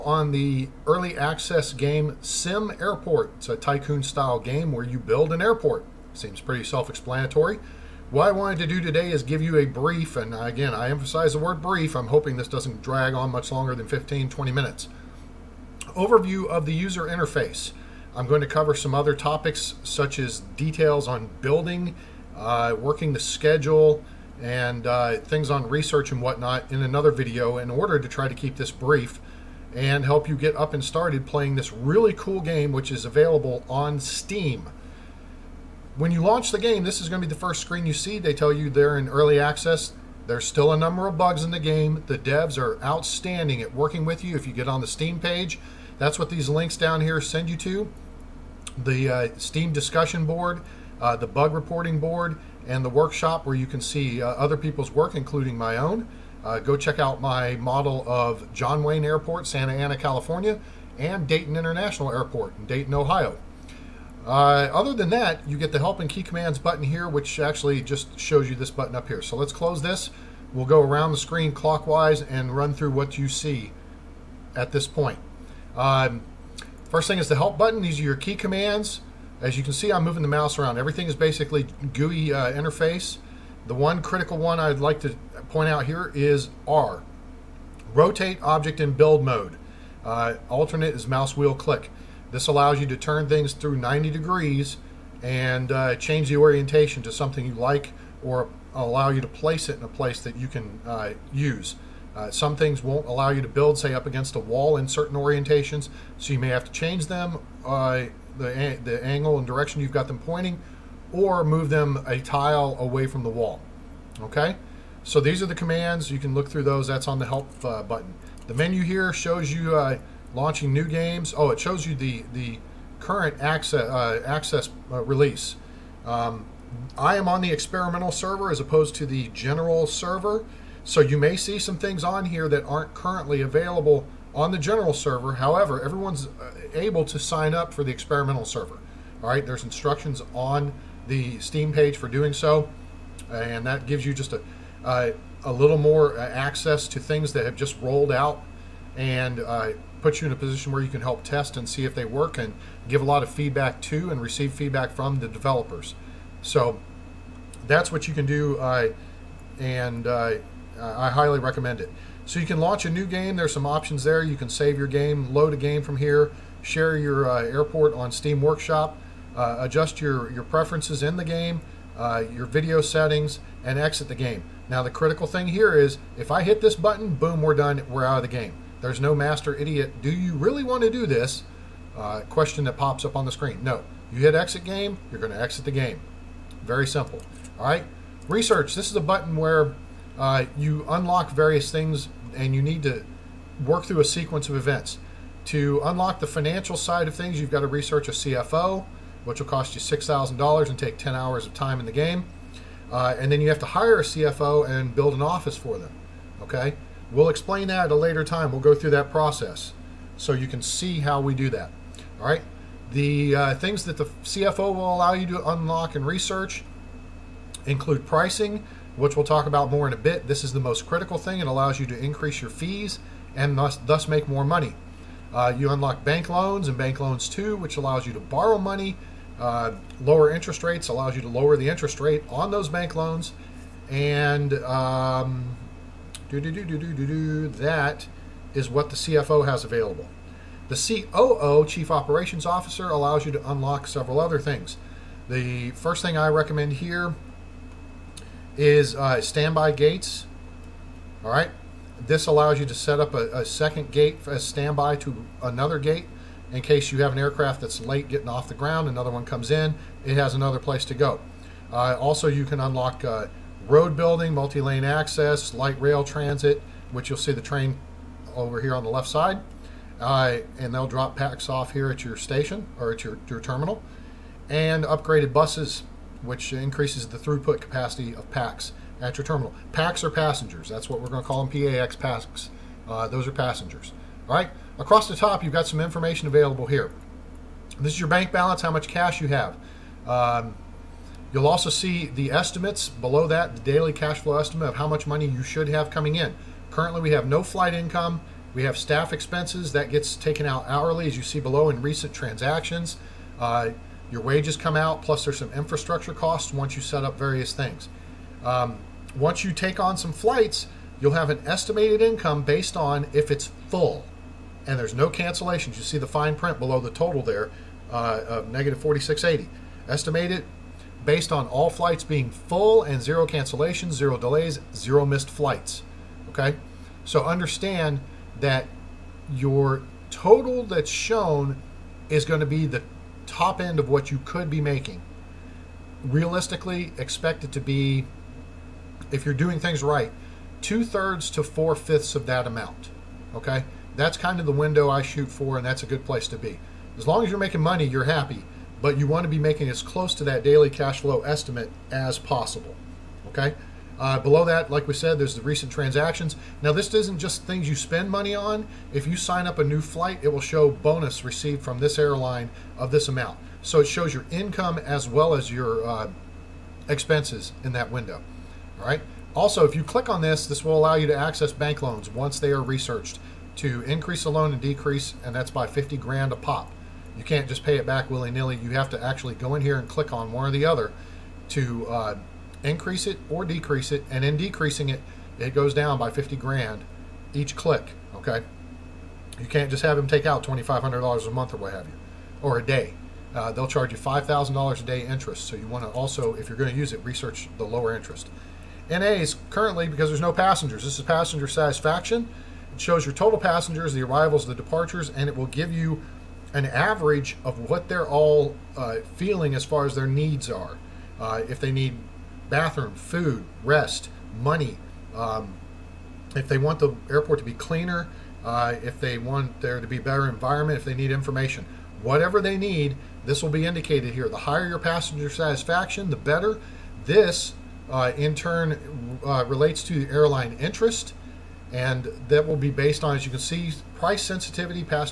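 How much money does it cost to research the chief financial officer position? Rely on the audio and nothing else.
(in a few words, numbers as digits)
$6,000.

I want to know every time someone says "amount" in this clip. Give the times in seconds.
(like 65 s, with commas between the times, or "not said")
342 s, 363 s.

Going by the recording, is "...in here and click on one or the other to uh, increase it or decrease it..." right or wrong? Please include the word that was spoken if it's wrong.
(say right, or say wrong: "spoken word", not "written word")
right.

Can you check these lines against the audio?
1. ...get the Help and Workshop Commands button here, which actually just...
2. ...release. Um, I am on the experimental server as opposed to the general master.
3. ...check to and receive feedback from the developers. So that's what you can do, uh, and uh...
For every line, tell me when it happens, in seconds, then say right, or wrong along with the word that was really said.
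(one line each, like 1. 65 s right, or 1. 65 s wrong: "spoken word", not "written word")
1. 65 s wrong: "Key", not "Workshop"
2. 125 s wrong: "server", not "master"
3. 153 s wrong: "feedback", not "check".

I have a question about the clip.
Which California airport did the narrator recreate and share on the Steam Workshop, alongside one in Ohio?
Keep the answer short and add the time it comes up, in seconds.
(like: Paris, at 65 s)
John Wayne Airport, at 58 s.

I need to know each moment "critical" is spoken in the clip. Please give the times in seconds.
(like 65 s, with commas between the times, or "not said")
84 s, 174 s, 220 s.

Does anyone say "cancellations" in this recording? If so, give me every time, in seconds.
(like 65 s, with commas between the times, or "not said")
315 s, 323 s.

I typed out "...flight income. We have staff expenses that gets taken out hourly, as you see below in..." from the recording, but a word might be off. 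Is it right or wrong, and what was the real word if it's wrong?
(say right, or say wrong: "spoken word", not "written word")
right.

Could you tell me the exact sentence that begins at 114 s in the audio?
Okay, so these are the commands.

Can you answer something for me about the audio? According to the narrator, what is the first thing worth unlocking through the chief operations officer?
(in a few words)
standby gates.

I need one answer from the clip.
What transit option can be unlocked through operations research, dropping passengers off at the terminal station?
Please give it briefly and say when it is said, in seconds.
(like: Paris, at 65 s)
light rail transit, at 265 s.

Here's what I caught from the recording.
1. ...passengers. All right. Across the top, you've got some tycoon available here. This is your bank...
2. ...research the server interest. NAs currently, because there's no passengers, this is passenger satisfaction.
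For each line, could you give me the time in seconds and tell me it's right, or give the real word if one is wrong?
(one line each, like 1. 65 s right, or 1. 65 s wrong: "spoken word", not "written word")
1. 283 s wrong: "information", not "tycoon"
2. 397 s wrong: "lower", not "server".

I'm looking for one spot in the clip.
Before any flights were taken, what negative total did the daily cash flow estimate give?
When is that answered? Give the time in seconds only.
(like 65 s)
318 s.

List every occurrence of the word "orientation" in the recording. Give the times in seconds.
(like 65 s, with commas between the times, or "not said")
96 s, 105 s.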